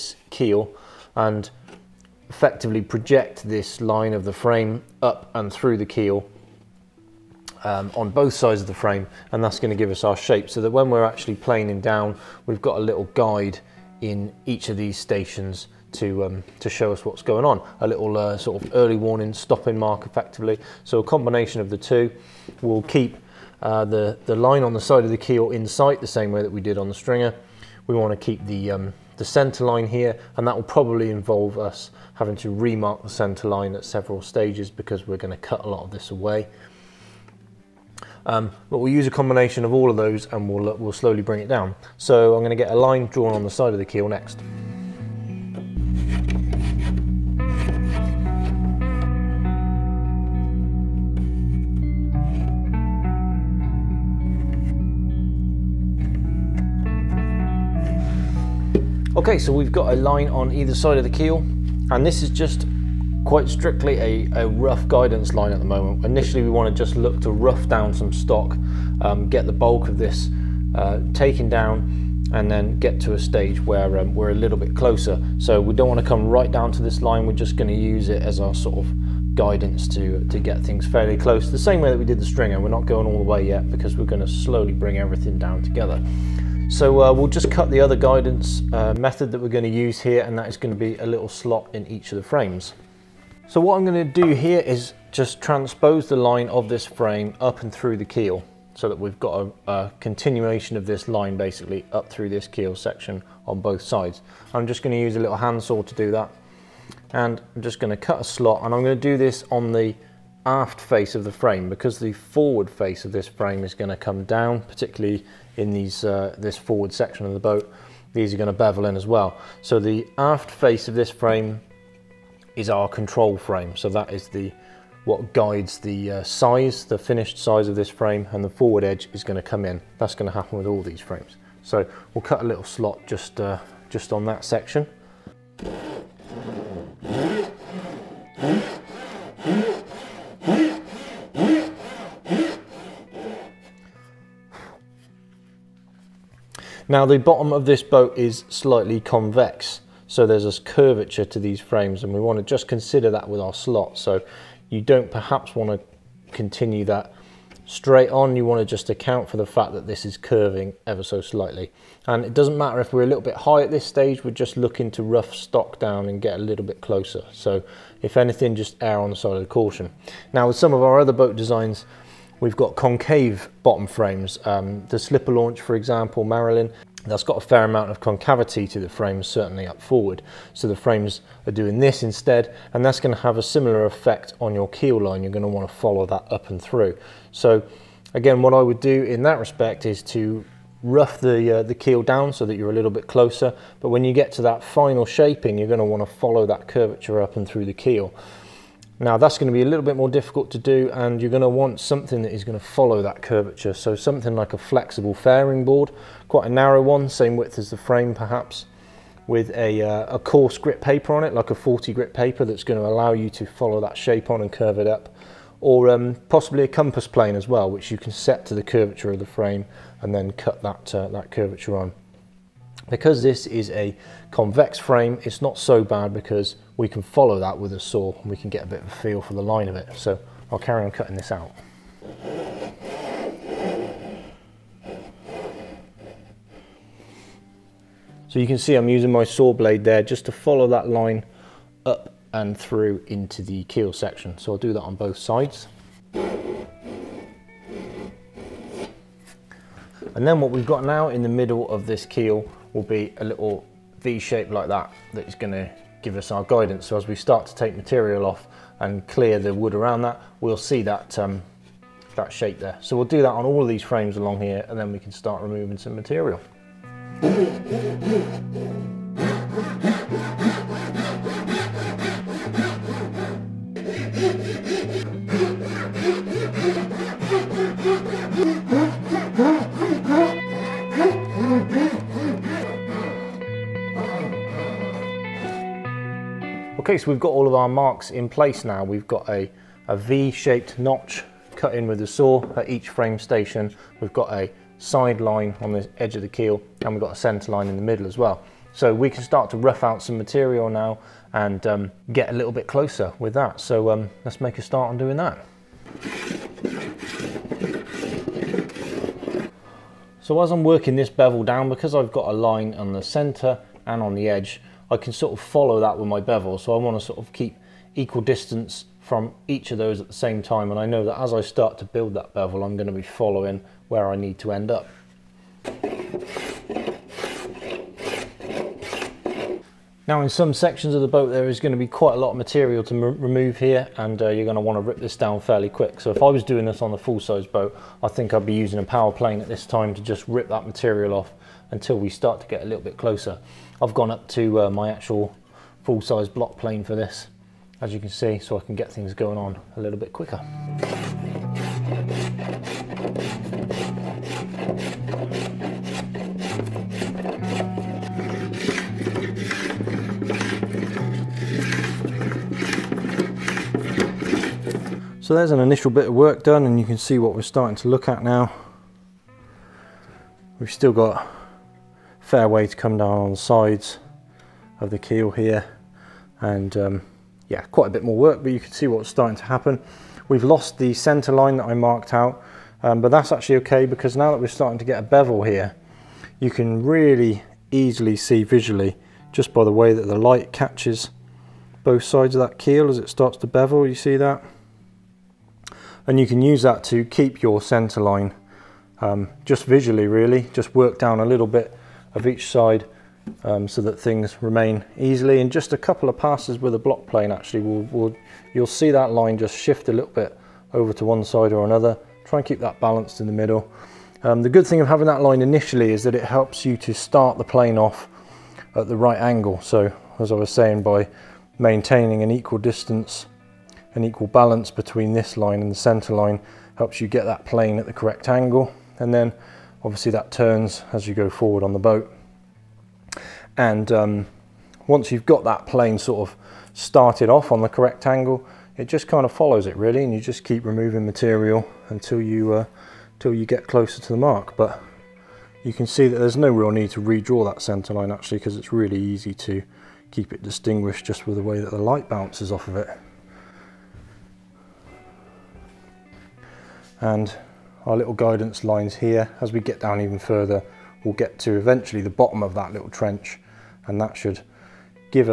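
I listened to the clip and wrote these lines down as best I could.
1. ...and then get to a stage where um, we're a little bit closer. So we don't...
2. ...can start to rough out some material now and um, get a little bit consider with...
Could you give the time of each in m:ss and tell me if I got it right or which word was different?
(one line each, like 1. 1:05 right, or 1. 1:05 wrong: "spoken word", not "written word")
1. 1:12 right
2. 4:59 wrong: "closer", not "consider".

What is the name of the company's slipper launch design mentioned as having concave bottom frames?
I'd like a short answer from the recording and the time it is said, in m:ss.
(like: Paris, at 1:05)
Marilyn, at 2:56.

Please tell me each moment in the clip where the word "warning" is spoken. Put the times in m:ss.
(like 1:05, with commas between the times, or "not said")
0:18.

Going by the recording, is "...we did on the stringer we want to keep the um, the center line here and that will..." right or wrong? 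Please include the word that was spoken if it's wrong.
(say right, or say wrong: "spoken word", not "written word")
right.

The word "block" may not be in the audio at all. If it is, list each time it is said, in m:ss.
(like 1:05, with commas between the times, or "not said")
5:46, 6:46.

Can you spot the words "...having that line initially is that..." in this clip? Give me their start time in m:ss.
6:54.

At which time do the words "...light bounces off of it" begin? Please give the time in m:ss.
7:31.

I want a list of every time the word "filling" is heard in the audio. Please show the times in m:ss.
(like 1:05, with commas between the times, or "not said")
not said.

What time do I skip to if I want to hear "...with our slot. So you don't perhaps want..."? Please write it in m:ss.
2:33.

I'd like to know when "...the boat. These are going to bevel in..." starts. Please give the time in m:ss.
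1:57.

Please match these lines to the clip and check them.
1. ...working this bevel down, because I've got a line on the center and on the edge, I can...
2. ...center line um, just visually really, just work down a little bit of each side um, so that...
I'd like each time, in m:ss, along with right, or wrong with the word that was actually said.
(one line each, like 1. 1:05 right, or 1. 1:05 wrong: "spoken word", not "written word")
1. 5:10 right
2. 6:37 right.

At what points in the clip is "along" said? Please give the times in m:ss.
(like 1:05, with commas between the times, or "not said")
4:24.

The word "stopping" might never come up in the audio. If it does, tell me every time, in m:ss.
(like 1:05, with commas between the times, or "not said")
0:19.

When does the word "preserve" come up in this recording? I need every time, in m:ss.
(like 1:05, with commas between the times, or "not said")
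not said.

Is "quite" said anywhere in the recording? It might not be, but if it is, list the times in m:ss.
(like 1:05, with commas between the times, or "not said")
1:03, 3:26, 5:31, 6:17.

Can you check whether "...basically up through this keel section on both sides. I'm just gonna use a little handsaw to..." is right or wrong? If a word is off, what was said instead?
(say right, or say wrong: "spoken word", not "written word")
right.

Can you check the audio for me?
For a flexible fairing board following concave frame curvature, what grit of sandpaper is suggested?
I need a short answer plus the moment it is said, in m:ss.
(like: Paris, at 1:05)
40, at 3:31.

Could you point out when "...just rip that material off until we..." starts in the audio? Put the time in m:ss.
5:40.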